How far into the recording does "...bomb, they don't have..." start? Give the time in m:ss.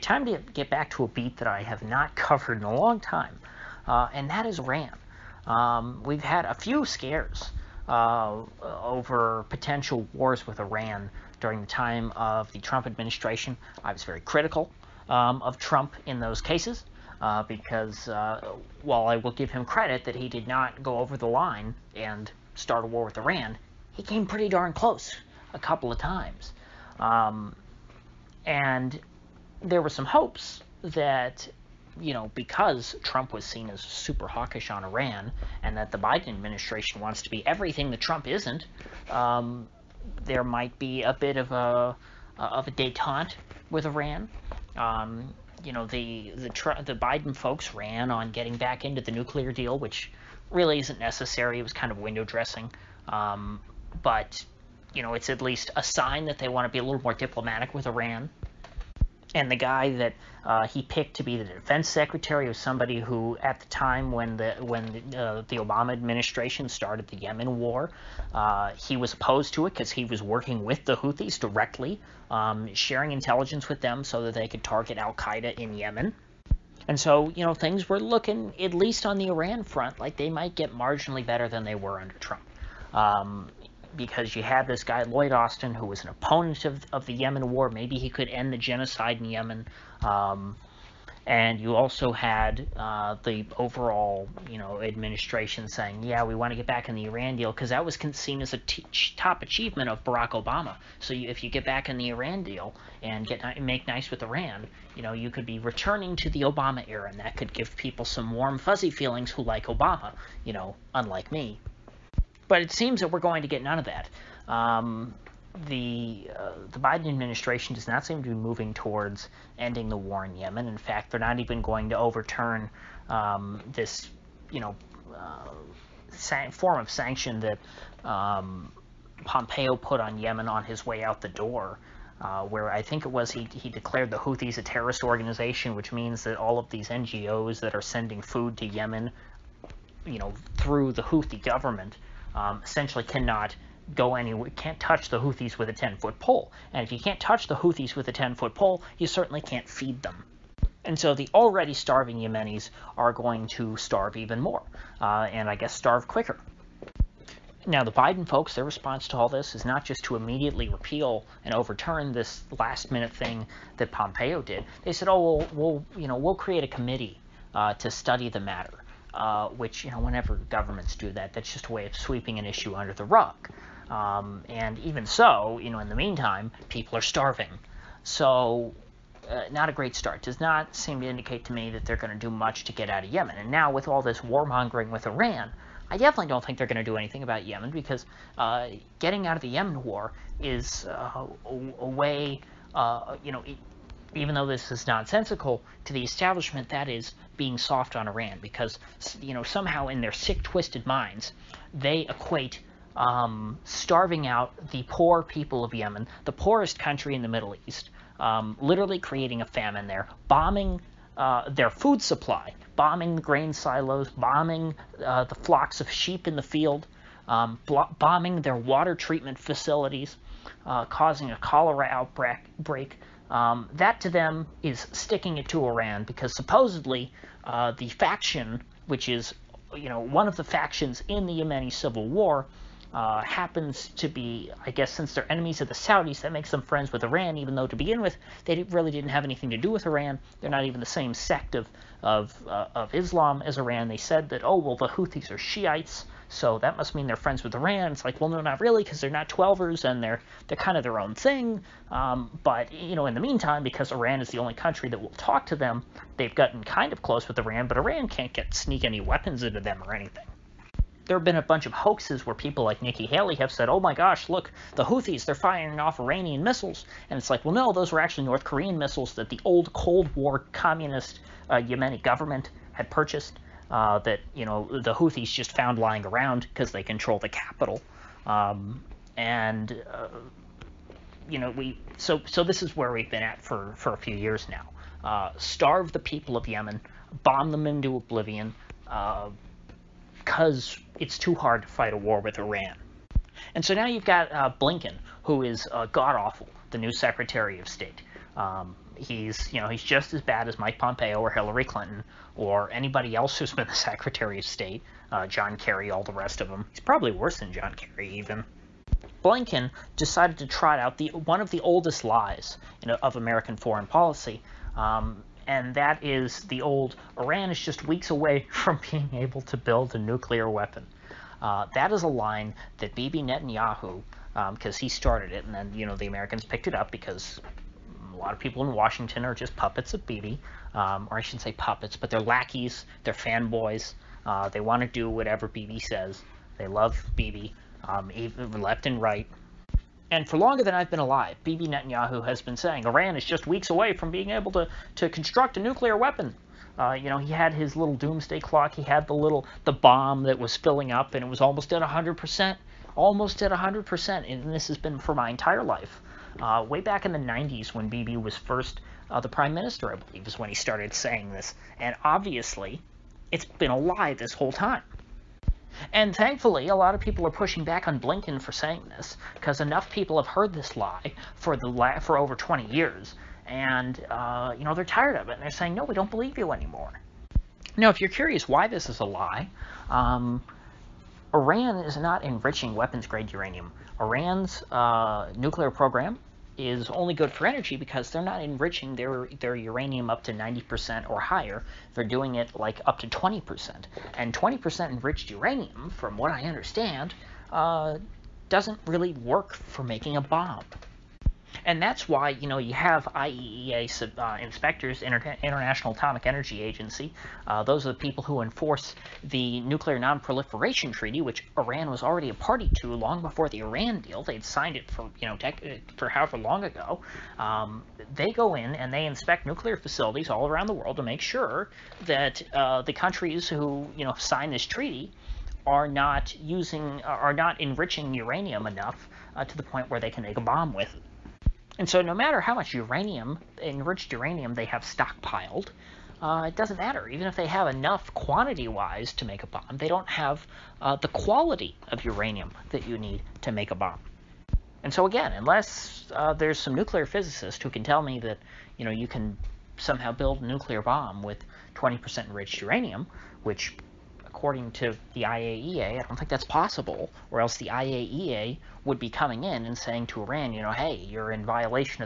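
7:19.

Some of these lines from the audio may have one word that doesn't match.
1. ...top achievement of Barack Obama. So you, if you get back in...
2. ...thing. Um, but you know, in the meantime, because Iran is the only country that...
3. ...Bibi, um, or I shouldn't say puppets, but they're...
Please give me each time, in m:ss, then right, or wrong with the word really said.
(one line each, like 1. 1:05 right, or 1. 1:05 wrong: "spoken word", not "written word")
1. 1:39 right
2. 4:11 right
3. 5:30 right.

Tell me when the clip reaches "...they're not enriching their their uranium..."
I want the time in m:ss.
6:28.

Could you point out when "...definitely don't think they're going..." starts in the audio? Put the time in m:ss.
3:05.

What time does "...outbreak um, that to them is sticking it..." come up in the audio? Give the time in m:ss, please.
3:41.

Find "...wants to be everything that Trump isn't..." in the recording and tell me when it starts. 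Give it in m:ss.
0:36.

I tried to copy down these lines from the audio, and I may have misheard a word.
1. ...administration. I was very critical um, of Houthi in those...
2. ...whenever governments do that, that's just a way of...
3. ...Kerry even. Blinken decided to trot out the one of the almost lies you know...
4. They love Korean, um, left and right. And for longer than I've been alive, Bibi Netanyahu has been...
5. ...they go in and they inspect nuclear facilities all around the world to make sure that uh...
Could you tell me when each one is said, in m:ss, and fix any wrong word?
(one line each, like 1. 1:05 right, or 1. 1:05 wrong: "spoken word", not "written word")
1. 0:12 wrong: "Trump", not "Houthi"
2. 2:49 right
3. 5:07 wrong: "oldest", not "almost"
4. 5:36 wrong: "Bibi", not "Korean"
5. 6:58 right.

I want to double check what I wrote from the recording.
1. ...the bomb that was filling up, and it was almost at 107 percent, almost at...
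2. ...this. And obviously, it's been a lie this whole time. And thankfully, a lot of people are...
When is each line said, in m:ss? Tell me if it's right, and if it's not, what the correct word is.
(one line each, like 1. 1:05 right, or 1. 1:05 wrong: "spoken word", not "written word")
1. 5:49 wrong: "100", not "107"
2. 6:01 right.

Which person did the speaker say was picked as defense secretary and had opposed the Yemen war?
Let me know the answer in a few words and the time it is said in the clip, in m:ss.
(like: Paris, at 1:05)
Lloyd Austin, at 1:25.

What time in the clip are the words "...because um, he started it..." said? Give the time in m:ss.
5:24.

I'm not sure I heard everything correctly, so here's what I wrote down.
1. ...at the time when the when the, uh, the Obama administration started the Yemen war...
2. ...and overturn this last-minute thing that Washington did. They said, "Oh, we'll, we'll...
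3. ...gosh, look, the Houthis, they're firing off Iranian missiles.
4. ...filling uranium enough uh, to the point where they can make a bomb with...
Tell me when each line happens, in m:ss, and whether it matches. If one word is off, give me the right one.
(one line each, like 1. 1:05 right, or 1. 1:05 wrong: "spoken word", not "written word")
1. 1:03 right
2. 2:41 wrong: "Pompeo", not "Washington"
3. 4:23 right
4. 7:07 wrong: "enriching", not "filling".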